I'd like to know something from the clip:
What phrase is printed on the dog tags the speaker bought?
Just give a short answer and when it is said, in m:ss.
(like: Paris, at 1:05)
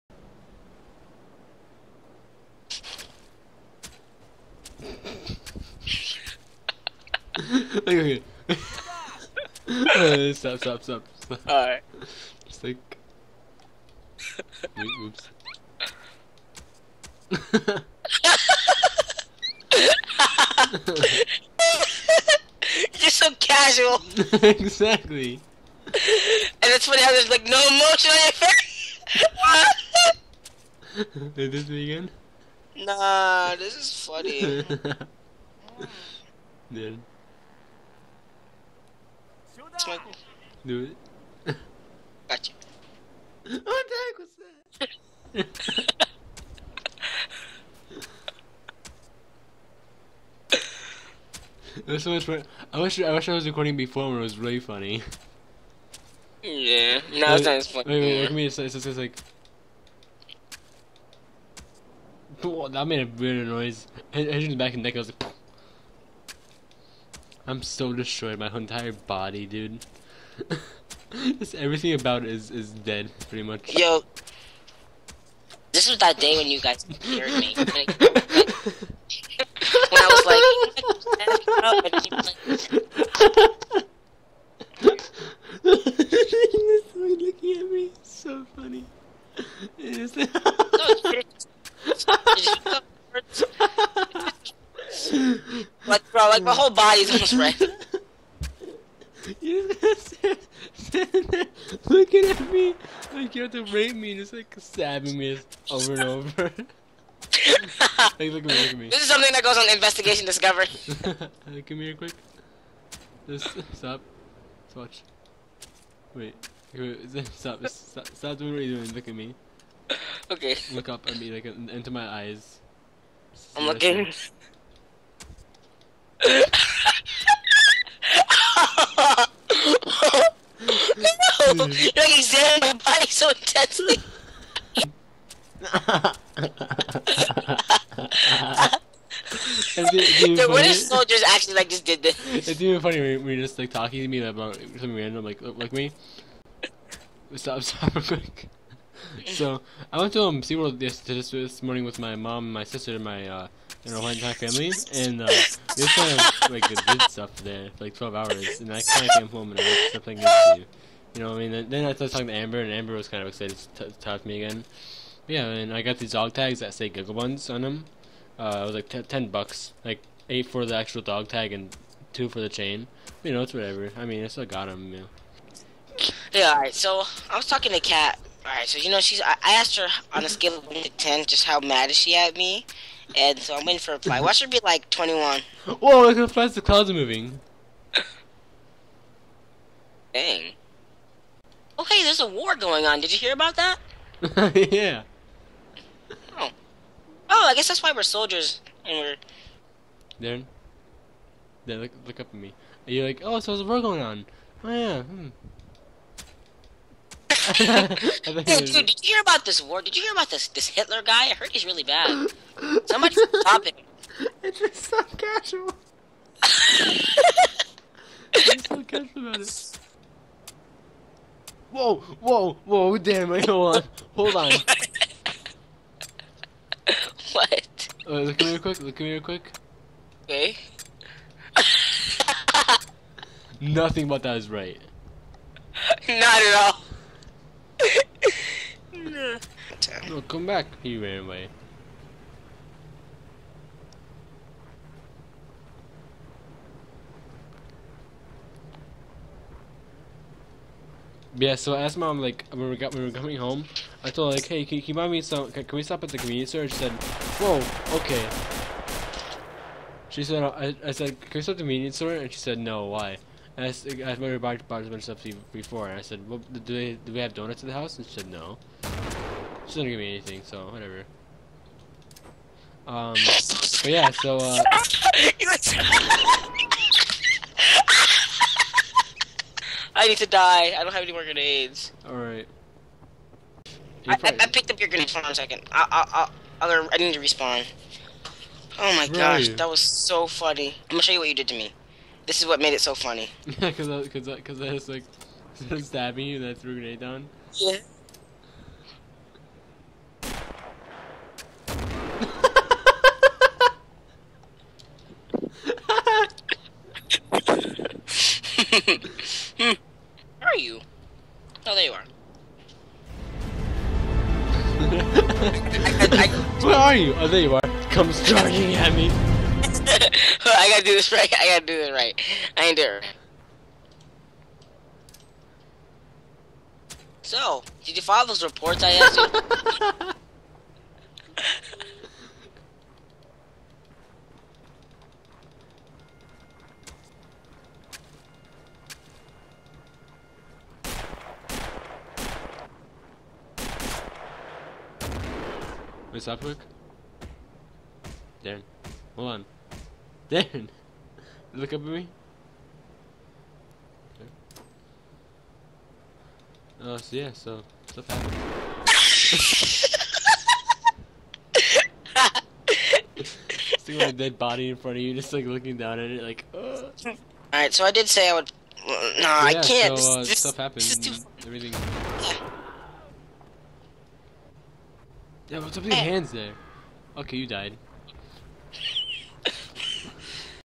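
Giggle Buns, at 2:46.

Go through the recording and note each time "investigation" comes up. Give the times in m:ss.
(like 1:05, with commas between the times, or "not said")
1:49.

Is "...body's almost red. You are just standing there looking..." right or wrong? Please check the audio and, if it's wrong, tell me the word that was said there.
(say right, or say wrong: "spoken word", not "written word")
right.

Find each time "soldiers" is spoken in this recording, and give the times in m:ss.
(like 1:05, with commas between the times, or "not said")
2:20, 3:18.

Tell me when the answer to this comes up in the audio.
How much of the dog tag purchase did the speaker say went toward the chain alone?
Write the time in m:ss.
2:52.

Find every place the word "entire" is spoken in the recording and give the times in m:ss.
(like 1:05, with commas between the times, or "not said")
1:08, 2:34.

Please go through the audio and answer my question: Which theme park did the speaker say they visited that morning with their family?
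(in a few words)
SeaWorld.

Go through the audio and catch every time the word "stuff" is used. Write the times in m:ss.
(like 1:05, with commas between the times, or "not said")
2:37, 4:25, 5:57, 6:10.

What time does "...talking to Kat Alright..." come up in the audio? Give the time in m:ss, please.
2:57.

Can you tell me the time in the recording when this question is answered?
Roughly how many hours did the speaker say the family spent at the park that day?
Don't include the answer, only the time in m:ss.
2:37.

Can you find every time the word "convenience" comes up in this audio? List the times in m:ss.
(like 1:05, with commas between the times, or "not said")
4:16, 4:21.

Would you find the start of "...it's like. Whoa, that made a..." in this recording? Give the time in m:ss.
0:58.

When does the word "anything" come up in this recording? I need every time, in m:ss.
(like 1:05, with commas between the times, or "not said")
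4:30.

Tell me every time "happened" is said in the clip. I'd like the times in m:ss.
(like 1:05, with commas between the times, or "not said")
3:59, 5:58, 6:10.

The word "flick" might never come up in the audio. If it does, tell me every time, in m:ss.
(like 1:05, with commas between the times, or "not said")
not said.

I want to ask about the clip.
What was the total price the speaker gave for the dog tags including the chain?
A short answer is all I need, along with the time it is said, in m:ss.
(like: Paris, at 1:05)
10 bucks, at 2:49.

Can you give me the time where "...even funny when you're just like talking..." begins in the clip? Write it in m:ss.
2:22.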